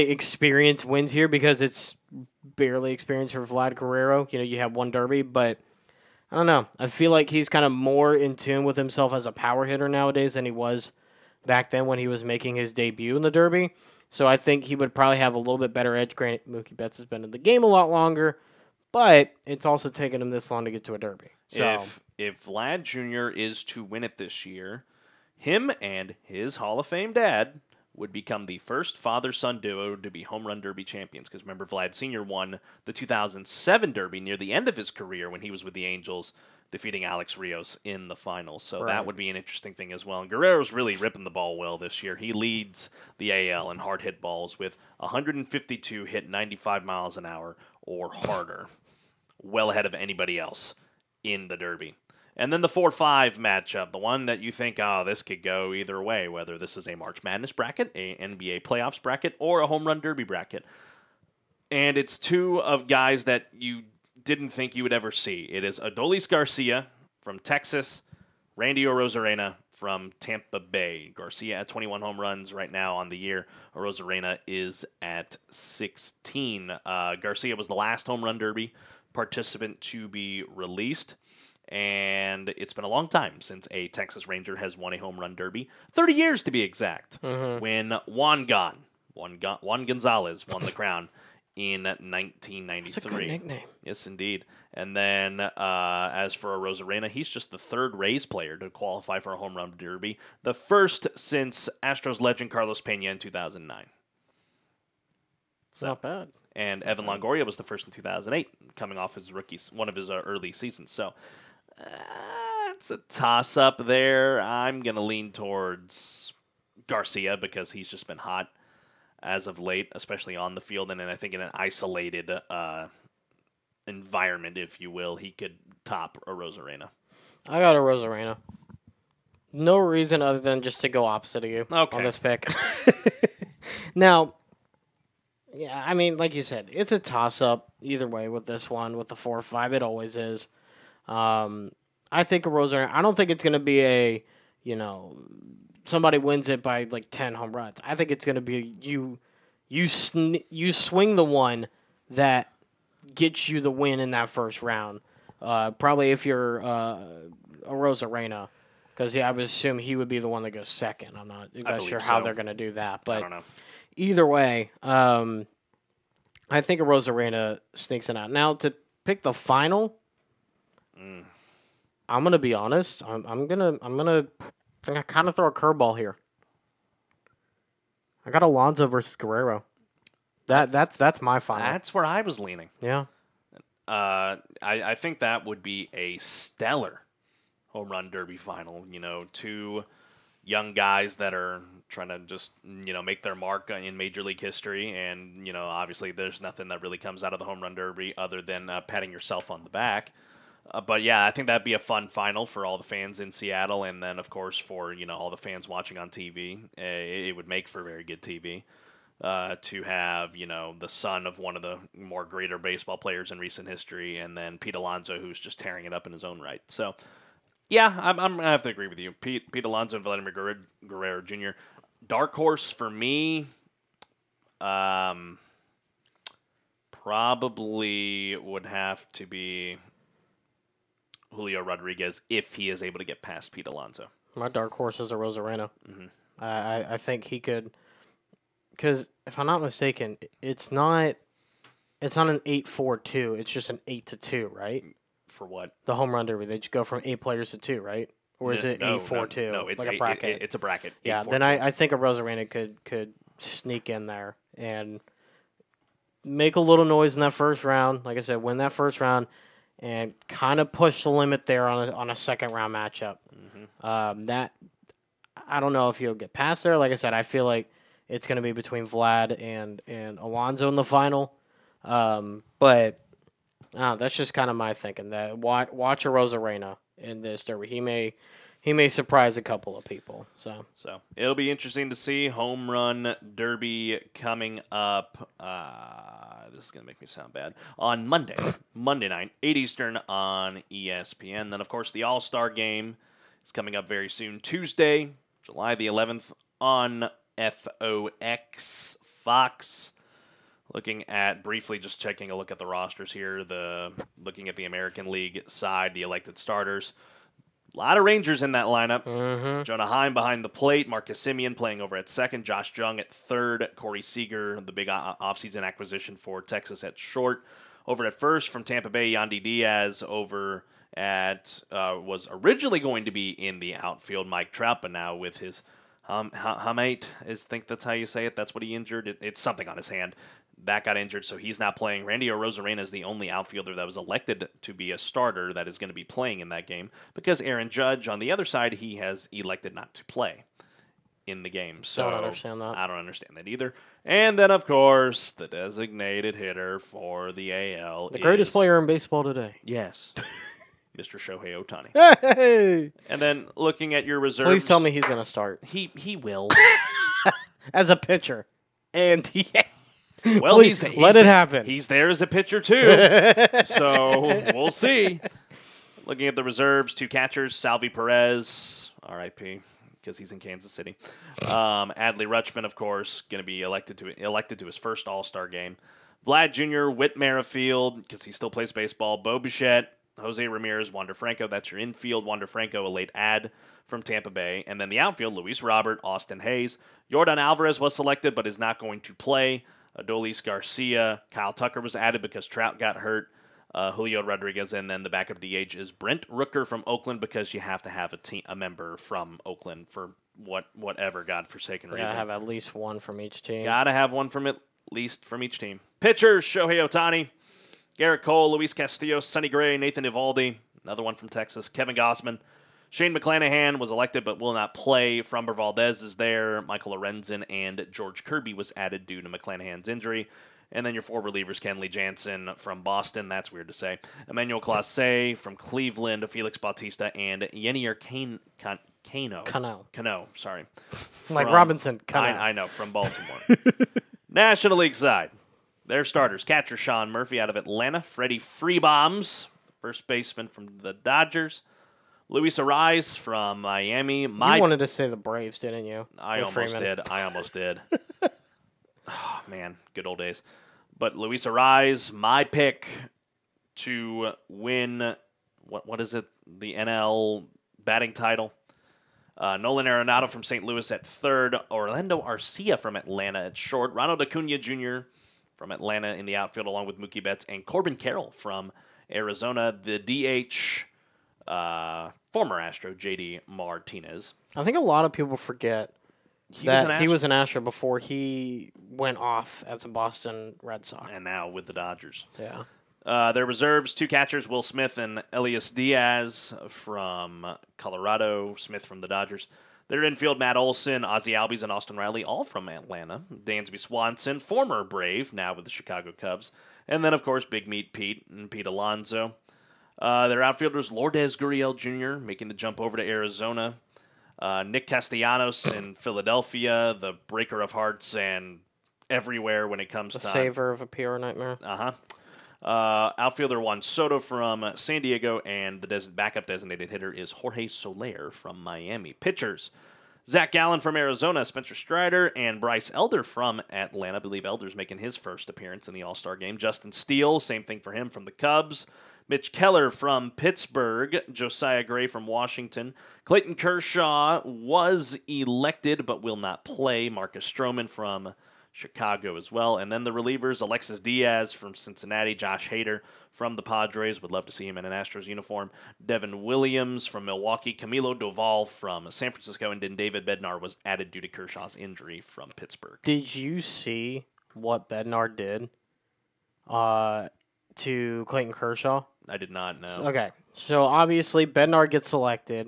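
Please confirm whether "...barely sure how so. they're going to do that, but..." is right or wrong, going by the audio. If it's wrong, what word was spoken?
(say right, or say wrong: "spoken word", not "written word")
wrong: "exactly", not "barely".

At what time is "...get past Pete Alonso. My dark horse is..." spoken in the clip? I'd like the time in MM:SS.
03:53.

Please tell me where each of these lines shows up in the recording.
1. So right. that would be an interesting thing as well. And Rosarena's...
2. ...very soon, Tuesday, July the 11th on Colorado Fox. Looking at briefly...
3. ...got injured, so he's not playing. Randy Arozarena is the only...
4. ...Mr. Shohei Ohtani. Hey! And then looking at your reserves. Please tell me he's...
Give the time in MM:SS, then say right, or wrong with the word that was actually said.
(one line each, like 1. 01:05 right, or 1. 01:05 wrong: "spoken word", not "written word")
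1. 00:38 wrong: "Guerrero", not "Rosarena"
2. 04:53 wrong: "FOX", not "Colorado"
3. 05:30 right
4. 05:50 right.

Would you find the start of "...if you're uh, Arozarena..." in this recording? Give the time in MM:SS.
02:36.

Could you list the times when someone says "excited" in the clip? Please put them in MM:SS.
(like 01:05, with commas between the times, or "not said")
not said.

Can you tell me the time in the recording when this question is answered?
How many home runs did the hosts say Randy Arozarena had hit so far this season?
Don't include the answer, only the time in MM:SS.
01:15.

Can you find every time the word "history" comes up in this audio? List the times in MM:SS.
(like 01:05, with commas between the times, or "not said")
03:14, 03:33.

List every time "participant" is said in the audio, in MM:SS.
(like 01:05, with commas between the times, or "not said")
01:19.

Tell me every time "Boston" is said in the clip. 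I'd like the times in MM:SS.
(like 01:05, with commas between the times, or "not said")
07:02, 07:59.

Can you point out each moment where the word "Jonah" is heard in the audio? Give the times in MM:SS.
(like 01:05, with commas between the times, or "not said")
05:09.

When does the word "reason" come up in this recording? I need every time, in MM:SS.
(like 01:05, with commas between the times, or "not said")
02:09, 06:41.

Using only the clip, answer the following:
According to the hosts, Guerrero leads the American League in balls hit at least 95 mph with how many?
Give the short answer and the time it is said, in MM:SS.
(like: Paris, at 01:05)
152, at 00:44.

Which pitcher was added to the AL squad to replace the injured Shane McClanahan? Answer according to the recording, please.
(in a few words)
George Kirby.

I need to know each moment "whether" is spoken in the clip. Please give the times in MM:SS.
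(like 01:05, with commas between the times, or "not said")
00:56.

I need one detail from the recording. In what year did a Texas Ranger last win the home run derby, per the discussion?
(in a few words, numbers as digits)
1993.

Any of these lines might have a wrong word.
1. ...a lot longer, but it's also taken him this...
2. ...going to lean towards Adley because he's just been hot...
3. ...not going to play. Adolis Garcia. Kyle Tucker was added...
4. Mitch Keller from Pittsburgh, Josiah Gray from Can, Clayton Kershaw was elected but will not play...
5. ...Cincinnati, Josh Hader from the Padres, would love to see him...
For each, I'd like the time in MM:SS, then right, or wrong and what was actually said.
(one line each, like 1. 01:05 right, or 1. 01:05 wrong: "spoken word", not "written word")
1. 00:17 right
2. 01:54 wrong: "Garcia", not "Adley"
3. 06:28 right
4. 08:49 wrong: "Washington", not "Can"
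5. 09:01 right.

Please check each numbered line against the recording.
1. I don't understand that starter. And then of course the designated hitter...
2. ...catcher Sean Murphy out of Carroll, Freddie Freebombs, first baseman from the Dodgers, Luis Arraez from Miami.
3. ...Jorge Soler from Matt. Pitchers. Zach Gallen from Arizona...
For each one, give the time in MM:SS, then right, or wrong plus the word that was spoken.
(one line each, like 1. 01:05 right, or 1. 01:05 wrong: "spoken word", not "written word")
1. 05:42 wrong: "either", not "starter"
2. 07:16 wrong: "Atlanta", not "Carroll"
3. 08:37 wrong: "Miami", not "Matt".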